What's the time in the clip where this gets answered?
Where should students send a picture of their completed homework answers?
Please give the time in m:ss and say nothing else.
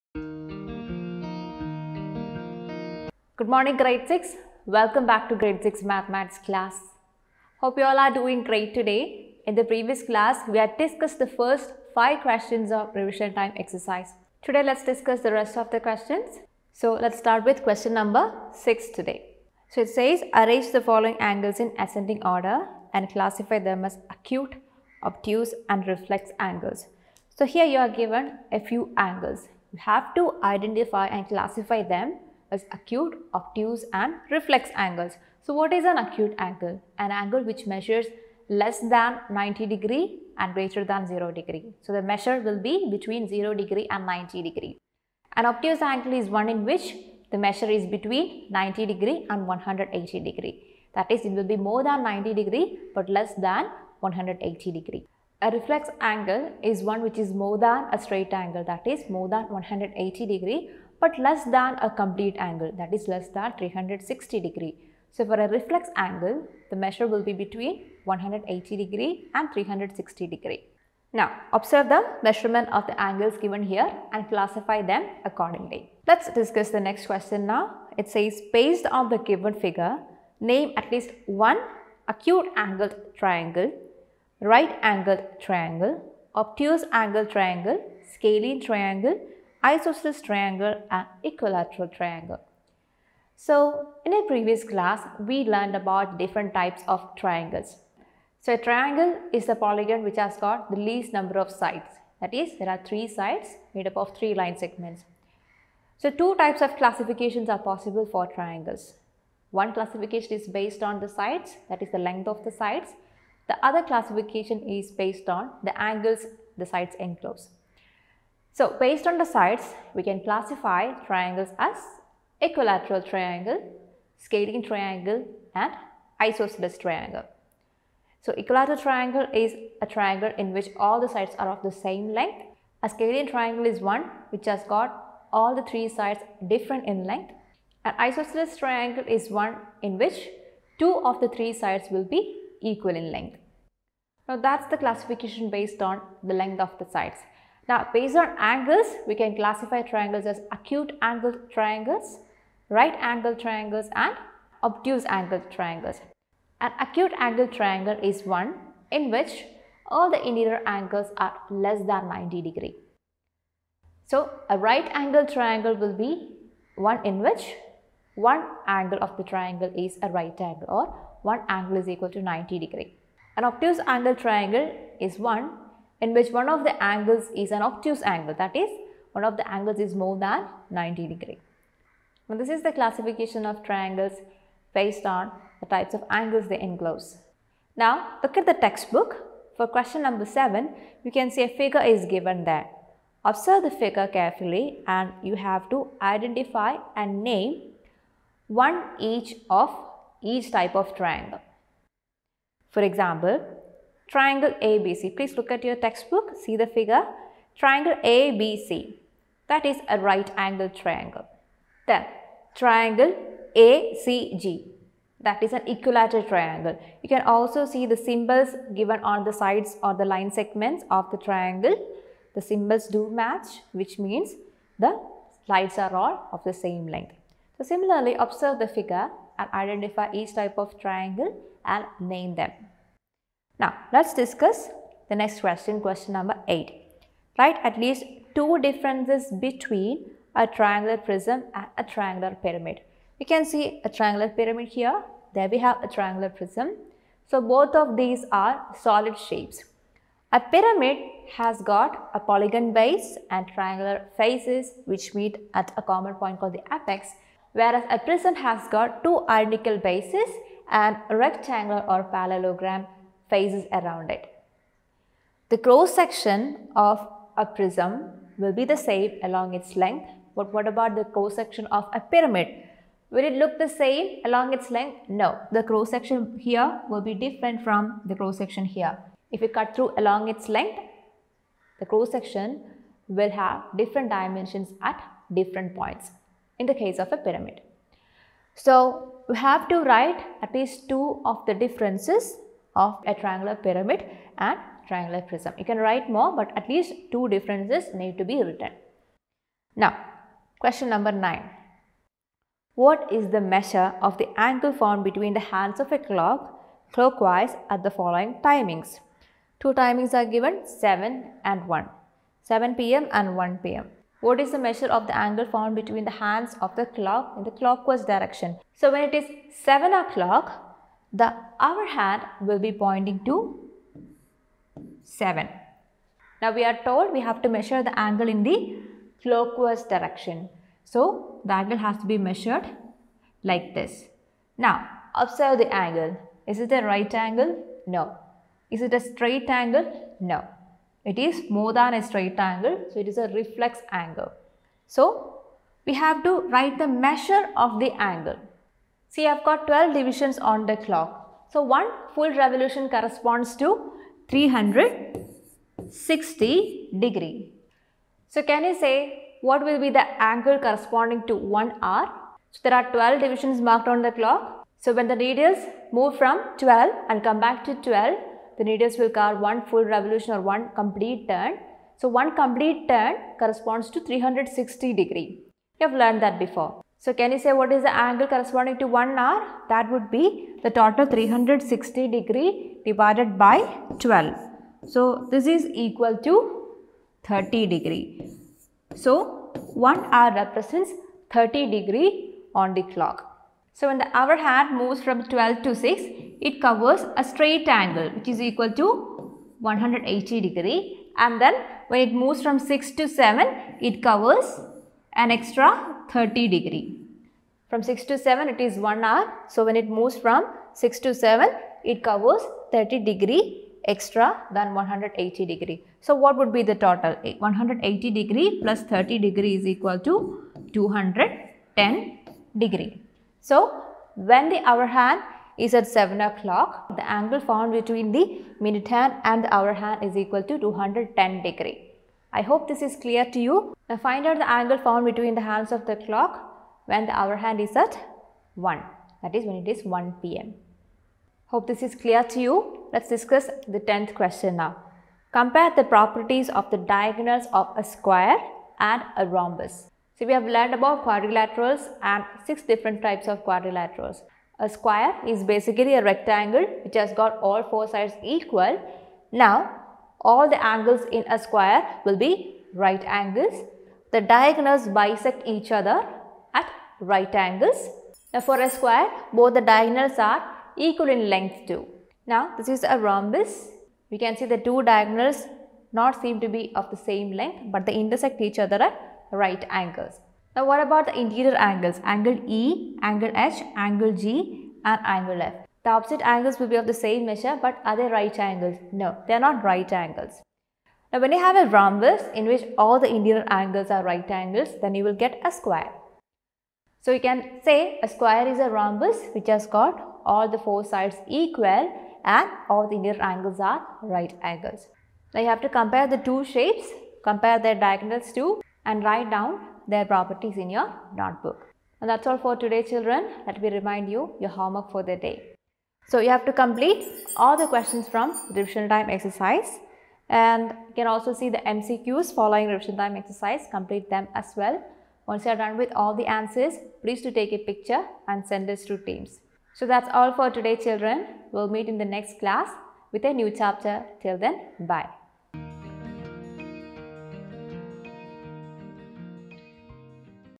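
8:48.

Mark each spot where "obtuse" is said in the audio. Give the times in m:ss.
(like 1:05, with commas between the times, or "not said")
0:25, 0:33, 0:45, 1:26, 2:34, 2:53, 2:57.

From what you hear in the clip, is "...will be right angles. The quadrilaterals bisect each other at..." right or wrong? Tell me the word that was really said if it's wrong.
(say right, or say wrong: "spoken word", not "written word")
wrong: "diagonals", not "quadrilaterals".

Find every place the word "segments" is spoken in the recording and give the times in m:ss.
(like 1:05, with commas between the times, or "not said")
1:44, 3:40.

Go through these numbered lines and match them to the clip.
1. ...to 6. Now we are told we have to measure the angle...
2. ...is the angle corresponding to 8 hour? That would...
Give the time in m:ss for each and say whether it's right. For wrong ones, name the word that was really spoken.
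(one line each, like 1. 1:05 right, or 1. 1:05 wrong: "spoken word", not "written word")
1. 5:23 wrong: "7", not "6"
2. 6:17 wrong: "1", not "8".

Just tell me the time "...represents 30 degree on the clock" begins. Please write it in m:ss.
6:30.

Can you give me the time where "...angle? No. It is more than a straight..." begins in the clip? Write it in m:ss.
5:39.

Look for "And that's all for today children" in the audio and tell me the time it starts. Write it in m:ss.
8:31.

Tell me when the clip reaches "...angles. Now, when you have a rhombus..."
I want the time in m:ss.
8:09.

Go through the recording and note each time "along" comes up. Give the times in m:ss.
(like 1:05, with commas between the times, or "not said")
4:29, 4:34, 4:39.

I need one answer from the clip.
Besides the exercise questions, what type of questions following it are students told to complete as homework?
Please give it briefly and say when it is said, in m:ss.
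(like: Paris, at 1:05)
MCQs, at 8:41.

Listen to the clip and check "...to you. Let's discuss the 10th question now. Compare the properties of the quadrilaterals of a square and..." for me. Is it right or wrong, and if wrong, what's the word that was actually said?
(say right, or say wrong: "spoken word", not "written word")
wrong: "diagonals", not "quadrilaterals".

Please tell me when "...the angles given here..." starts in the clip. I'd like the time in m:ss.
1:12.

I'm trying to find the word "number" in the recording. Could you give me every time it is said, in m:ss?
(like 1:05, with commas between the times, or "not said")
0:17, 1:41, 3:10, 3:56, 5:00.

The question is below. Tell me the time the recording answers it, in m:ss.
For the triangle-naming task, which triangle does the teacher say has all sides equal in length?
3:32.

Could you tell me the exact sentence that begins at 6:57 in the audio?
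180 degree plus 30 degree is equal to 210 degree.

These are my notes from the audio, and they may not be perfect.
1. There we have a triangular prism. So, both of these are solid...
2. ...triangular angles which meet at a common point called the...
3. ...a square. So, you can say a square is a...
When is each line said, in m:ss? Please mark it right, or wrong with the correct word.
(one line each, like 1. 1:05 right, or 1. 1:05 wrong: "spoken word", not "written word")
1. 4:05 right
2. 4:13 wrong: "faces", not "angles"
3. 8:15 right.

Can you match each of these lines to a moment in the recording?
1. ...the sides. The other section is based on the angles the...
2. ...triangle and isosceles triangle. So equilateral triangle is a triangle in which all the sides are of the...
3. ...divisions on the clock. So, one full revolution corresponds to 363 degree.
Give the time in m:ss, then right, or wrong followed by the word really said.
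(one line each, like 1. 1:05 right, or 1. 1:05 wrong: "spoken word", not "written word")
1. 1:52 wrong: "classification", not "section"
2. 2:04 right
3. 5:49 wrong: "360", not "363".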